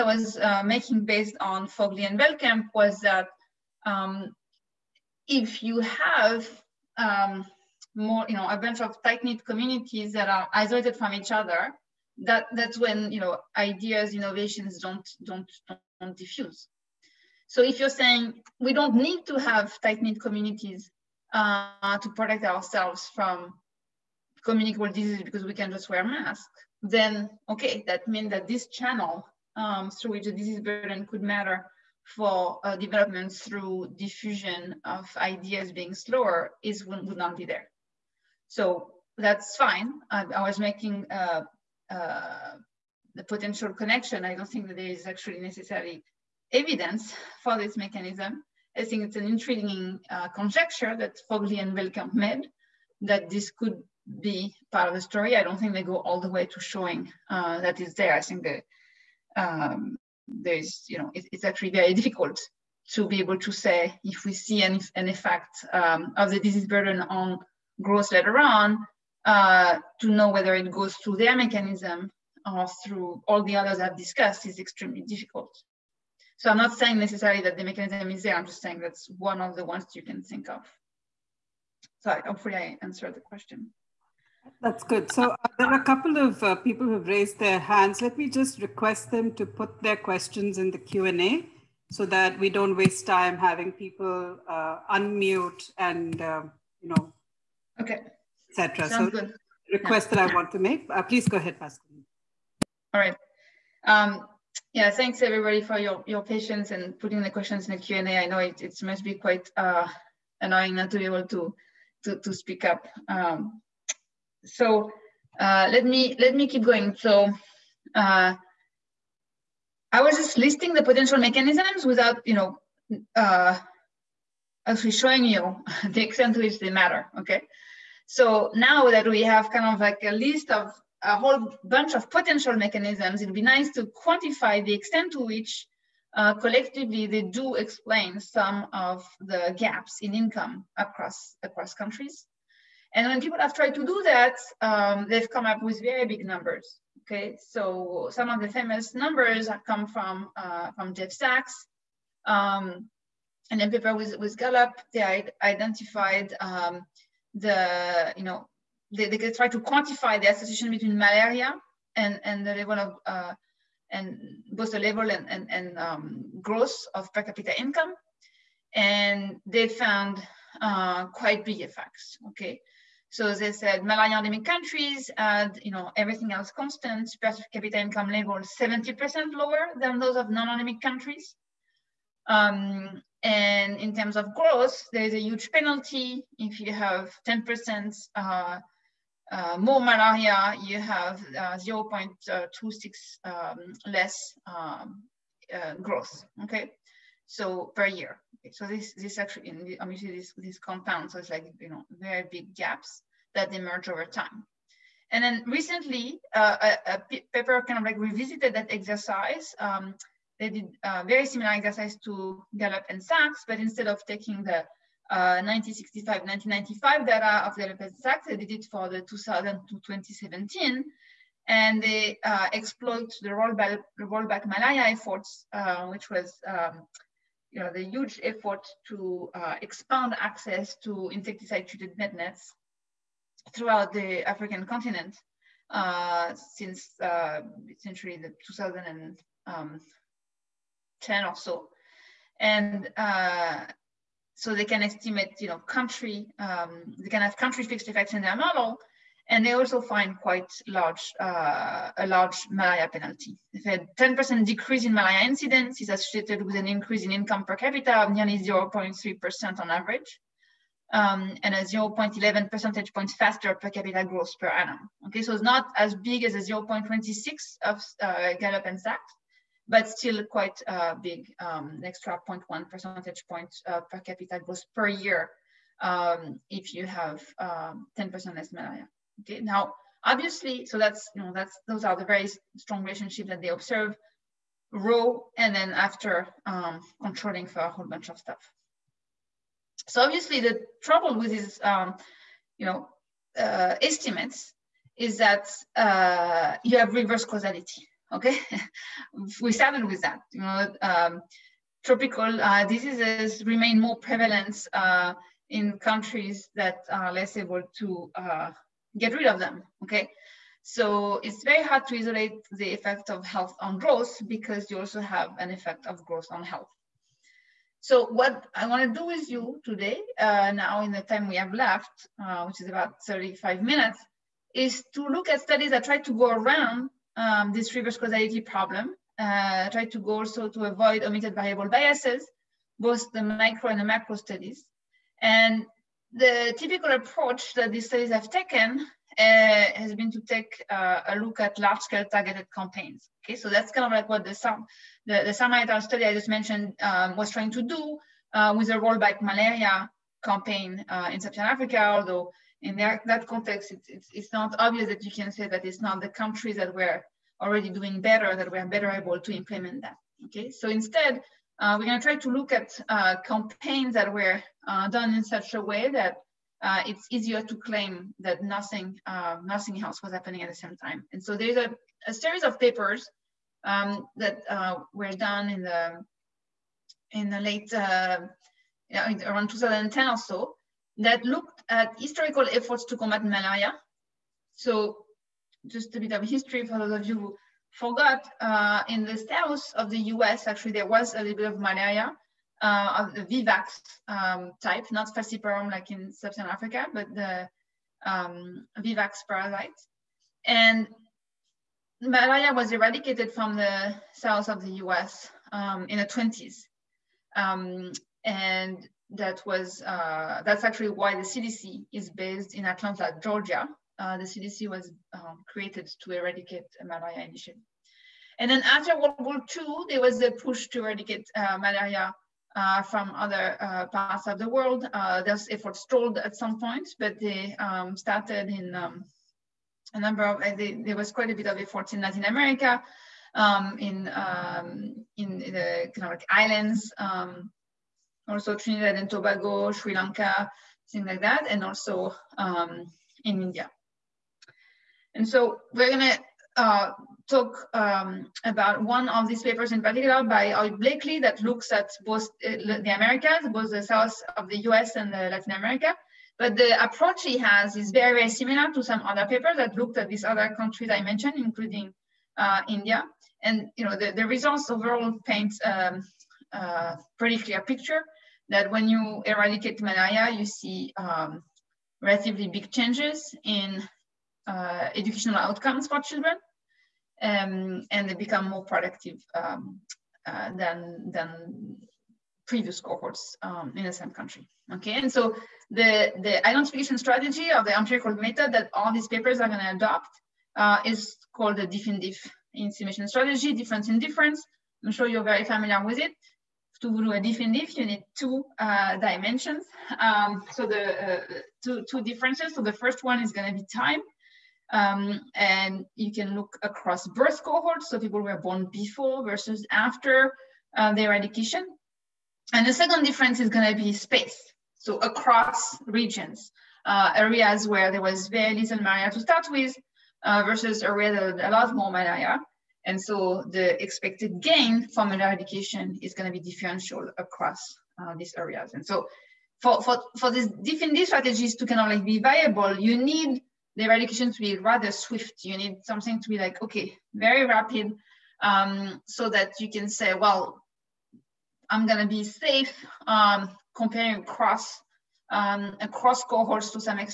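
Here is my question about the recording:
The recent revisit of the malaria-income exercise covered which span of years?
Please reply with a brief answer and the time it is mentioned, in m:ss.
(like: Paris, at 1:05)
2000 to 2017, at 3:39.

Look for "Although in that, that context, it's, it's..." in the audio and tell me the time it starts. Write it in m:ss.
5:51.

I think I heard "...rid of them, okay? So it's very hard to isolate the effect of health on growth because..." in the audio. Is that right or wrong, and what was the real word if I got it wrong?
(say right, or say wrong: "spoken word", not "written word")
right.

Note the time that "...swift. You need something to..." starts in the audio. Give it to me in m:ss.
8:54.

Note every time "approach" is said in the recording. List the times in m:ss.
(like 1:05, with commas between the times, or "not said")
5:36, 7:36.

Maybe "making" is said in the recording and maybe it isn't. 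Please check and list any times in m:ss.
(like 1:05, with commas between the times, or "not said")
0:00, 0:40.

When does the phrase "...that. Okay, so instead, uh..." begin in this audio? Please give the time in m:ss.
5:59.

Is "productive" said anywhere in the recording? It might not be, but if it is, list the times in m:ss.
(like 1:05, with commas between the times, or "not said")
7:58.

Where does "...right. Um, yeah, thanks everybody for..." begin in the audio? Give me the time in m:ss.
1:42.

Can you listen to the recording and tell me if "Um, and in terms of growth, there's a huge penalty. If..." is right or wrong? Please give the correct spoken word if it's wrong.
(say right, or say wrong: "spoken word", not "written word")
right.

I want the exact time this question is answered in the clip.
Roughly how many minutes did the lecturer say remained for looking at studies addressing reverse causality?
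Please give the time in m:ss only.
5:23.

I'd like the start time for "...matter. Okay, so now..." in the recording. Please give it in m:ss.
2:06.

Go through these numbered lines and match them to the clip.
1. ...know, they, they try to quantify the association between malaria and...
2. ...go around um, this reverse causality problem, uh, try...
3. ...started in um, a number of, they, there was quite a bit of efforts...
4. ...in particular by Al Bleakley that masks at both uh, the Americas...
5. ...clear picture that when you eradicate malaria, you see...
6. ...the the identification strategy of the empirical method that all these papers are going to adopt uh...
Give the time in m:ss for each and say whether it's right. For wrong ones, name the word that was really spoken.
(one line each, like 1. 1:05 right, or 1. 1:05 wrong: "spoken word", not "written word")
1. 2:38 right
2. 5:26 right
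3. 7:07 right
4. 7:29 wrong: "looks", not "masks"
5. 7:47 right
6. 8:05 right.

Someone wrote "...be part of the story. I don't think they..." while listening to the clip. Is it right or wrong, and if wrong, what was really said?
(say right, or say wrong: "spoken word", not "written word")
right.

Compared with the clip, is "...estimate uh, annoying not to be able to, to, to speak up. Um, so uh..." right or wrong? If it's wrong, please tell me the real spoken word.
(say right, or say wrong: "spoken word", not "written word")
wrong: "quite", not "estimate".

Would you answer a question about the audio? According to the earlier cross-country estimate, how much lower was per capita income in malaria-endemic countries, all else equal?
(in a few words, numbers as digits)
70%.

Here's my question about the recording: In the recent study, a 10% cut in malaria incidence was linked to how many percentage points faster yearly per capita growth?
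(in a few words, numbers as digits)
0.11.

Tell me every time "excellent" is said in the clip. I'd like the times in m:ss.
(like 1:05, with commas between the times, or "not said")
not said.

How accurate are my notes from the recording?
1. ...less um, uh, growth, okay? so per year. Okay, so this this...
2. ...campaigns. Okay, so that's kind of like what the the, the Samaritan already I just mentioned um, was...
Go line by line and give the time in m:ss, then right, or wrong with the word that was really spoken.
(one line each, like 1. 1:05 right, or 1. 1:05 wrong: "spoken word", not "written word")
1. 3:13 right
2. 5:42 wrong: "study", not "already".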